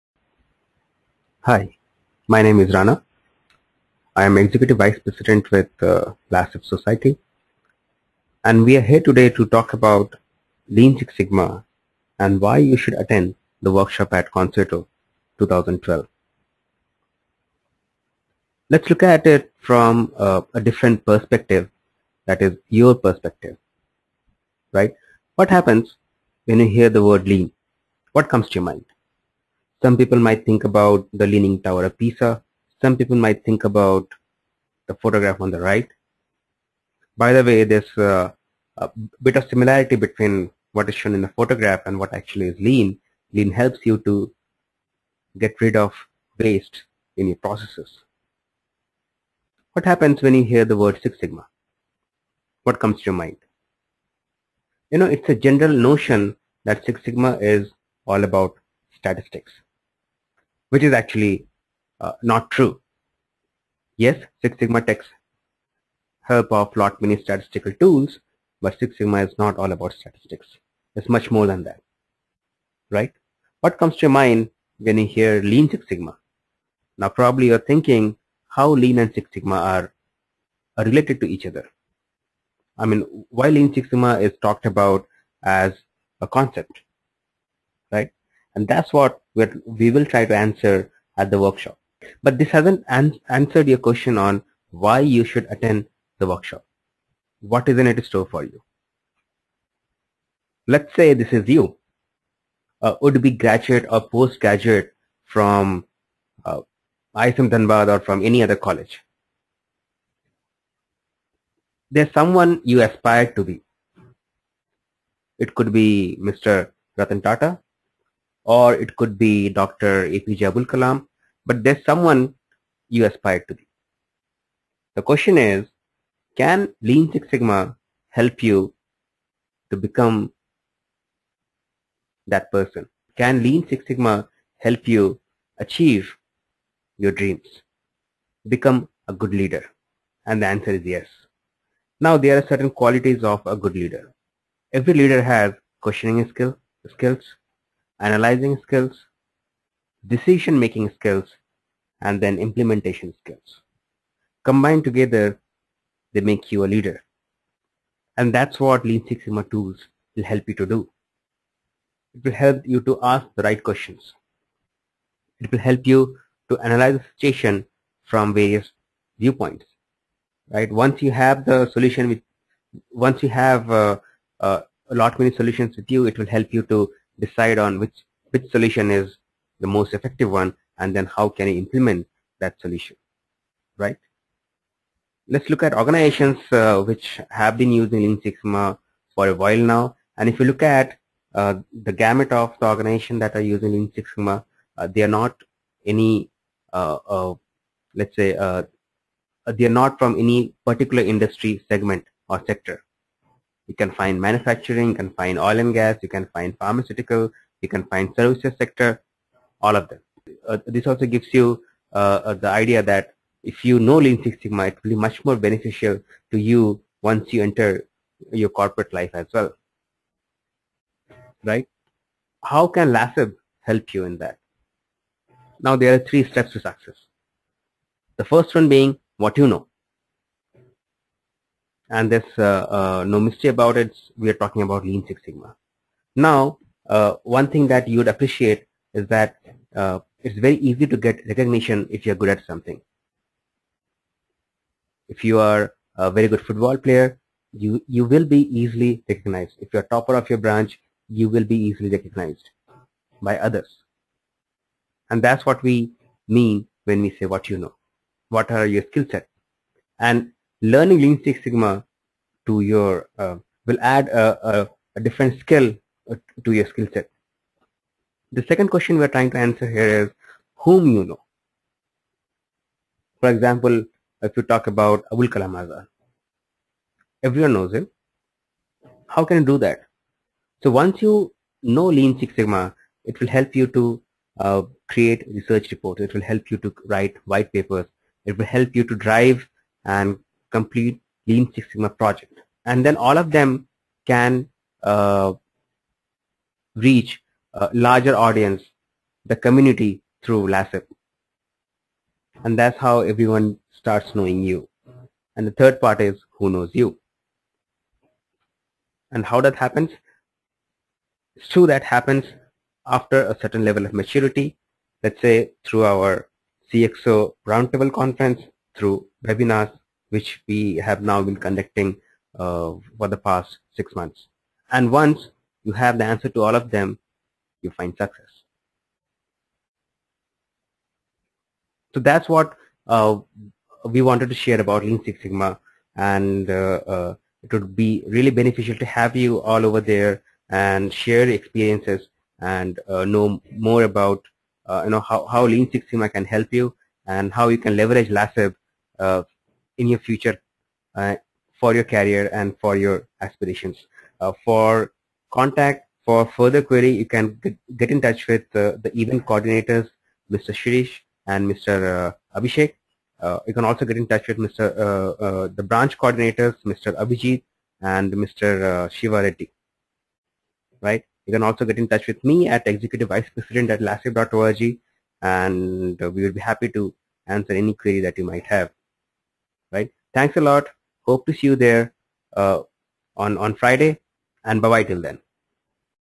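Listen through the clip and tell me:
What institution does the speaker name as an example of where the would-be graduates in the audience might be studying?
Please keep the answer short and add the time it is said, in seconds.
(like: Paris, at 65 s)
ISM Dhanbad, at 107 s.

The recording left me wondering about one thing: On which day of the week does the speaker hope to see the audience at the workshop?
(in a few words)
Friday.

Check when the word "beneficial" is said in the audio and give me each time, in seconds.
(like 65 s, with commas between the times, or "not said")
215 s, 338 s.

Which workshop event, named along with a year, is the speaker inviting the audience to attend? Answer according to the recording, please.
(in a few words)
Concetto 2012.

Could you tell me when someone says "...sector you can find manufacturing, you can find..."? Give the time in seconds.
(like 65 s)
202 s.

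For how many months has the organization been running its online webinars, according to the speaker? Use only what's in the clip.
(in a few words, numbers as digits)
6.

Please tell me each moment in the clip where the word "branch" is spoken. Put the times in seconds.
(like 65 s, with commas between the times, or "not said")
250 s, 365 s.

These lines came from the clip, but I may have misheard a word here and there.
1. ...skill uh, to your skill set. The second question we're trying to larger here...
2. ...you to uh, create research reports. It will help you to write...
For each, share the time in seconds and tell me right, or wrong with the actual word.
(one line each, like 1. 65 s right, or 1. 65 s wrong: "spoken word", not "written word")
1. 265 s wrong: "answer", not "larger"
2. 283 s right.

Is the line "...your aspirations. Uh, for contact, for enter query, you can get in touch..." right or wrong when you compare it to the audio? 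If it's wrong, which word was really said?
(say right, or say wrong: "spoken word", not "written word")
wrong: "further", not "enter".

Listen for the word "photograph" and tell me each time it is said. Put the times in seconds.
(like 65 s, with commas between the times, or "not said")
34 s, 41 s.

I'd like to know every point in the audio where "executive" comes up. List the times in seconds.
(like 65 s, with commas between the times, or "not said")
4 s, 372 s.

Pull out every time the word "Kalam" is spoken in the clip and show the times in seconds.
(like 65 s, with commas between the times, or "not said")
120 s, 275 s.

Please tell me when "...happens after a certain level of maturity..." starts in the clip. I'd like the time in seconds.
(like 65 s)
311 s.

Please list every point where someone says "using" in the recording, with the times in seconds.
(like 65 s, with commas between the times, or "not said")
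187 s, 193 s.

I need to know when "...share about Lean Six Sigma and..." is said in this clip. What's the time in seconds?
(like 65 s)
334 s.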